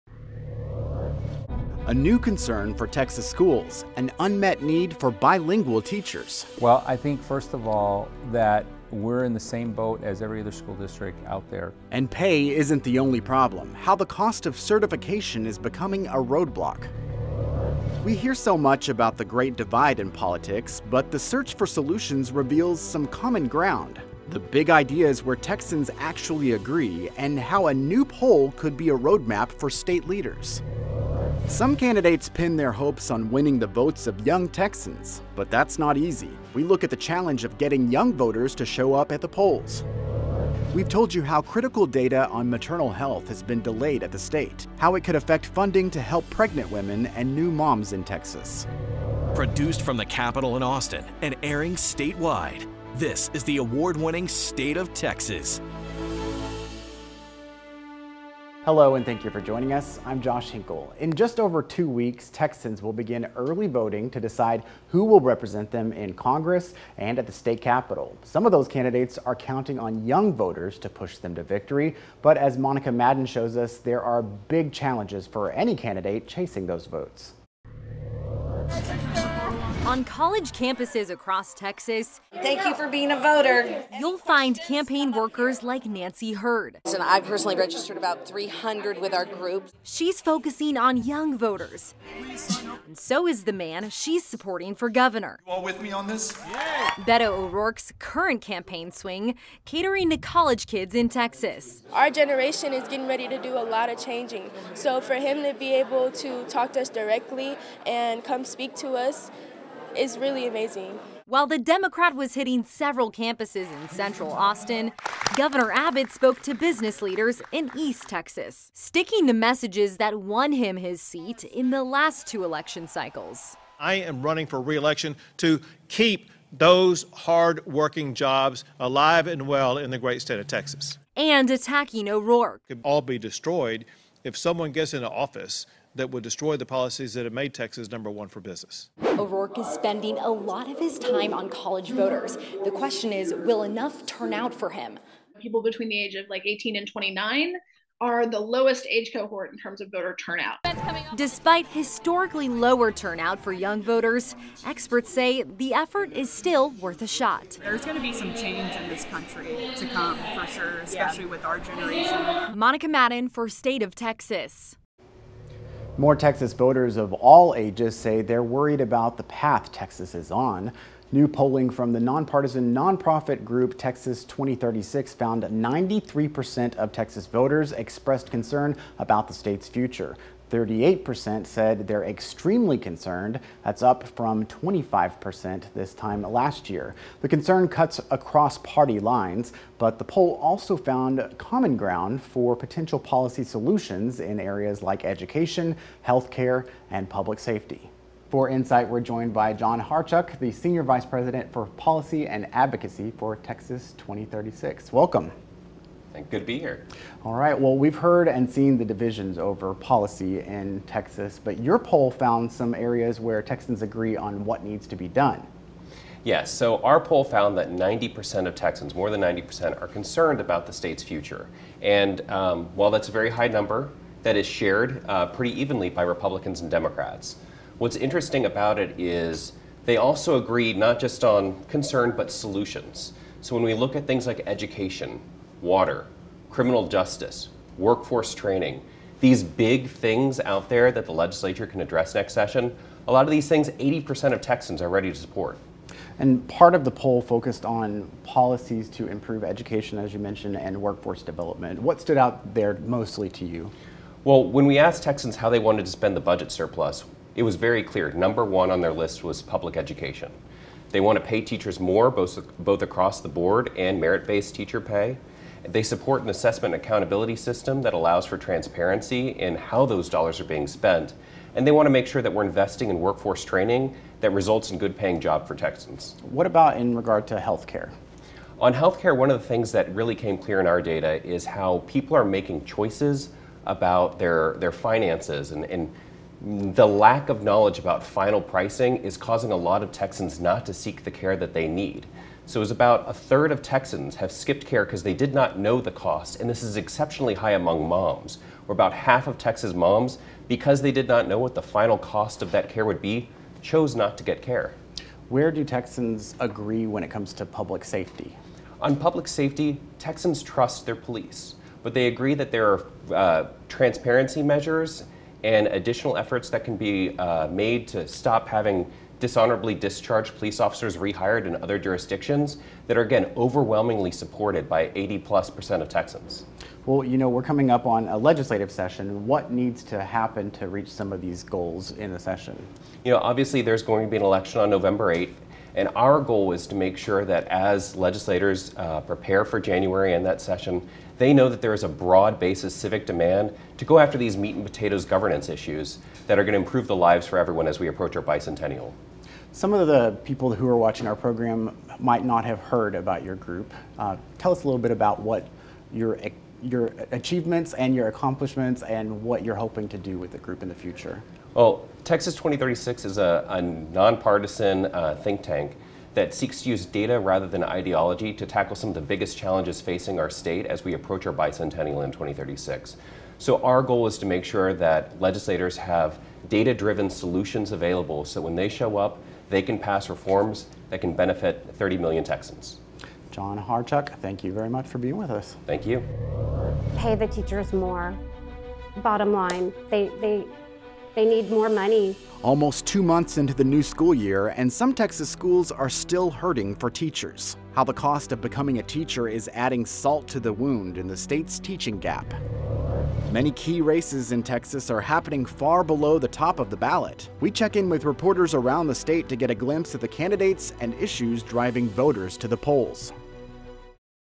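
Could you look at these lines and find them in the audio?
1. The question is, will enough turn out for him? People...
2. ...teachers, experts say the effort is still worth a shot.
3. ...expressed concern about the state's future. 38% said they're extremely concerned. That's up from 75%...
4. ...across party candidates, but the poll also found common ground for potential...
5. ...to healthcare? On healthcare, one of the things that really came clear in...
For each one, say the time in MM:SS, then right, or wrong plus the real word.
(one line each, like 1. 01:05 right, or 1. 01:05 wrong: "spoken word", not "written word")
1. 02:22 right
2. 02:33 wrong: "voters", not "teachers"
3. 02:57 wrong: "25", not "75"
4. 03:08 wrong: "lines", not "candidates"
5. 04:37 right.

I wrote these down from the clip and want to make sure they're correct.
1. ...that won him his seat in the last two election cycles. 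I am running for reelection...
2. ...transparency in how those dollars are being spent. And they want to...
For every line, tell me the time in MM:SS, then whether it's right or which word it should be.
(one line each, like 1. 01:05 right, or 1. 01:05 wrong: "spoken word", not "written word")
1. 01:59 right
2. 04:28 right.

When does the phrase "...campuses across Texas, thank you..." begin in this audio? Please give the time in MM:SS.
01:20.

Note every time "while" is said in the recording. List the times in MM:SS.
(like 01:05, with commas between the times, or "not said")
01:51, 03:42.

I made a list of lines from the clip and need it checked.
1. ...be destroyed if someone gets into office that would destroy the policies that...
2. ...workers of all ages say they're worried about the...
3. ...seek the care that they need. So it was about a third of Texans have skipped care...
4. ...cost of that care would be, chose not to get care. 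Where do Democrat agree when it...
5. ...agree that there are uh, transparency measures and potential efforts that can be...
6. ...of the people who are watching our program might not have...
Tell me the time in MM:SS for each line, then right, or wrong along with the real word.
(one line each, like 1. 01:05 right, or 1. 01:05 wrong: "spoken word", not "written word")
1. 02:13 right
2. 02:46 wrong: "voters", not "workers"
3. 04:50 right
4. 05:01 wrong: "Texans", not "Democrat"
5. 05:12 wrong: "additional", not "potential"
6. 05:49 right.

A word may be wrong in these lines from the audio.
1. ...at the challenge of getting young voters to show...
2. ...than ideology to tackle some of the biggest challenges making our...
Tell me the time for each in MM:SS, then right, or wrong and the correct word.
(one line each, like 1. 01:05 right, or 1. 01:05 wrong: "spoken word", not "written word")
1. 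00:36 right
2. 06:07 wrong: "facing", not "making".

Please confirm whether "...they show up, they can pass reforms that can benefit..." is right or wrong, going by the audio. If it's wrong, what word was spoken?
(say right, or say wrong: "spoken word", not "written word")
right.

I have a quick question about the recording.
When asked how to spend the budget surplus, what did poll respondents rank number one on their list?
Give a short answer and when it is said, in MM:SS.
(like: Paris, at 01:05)
public education, at 04:19.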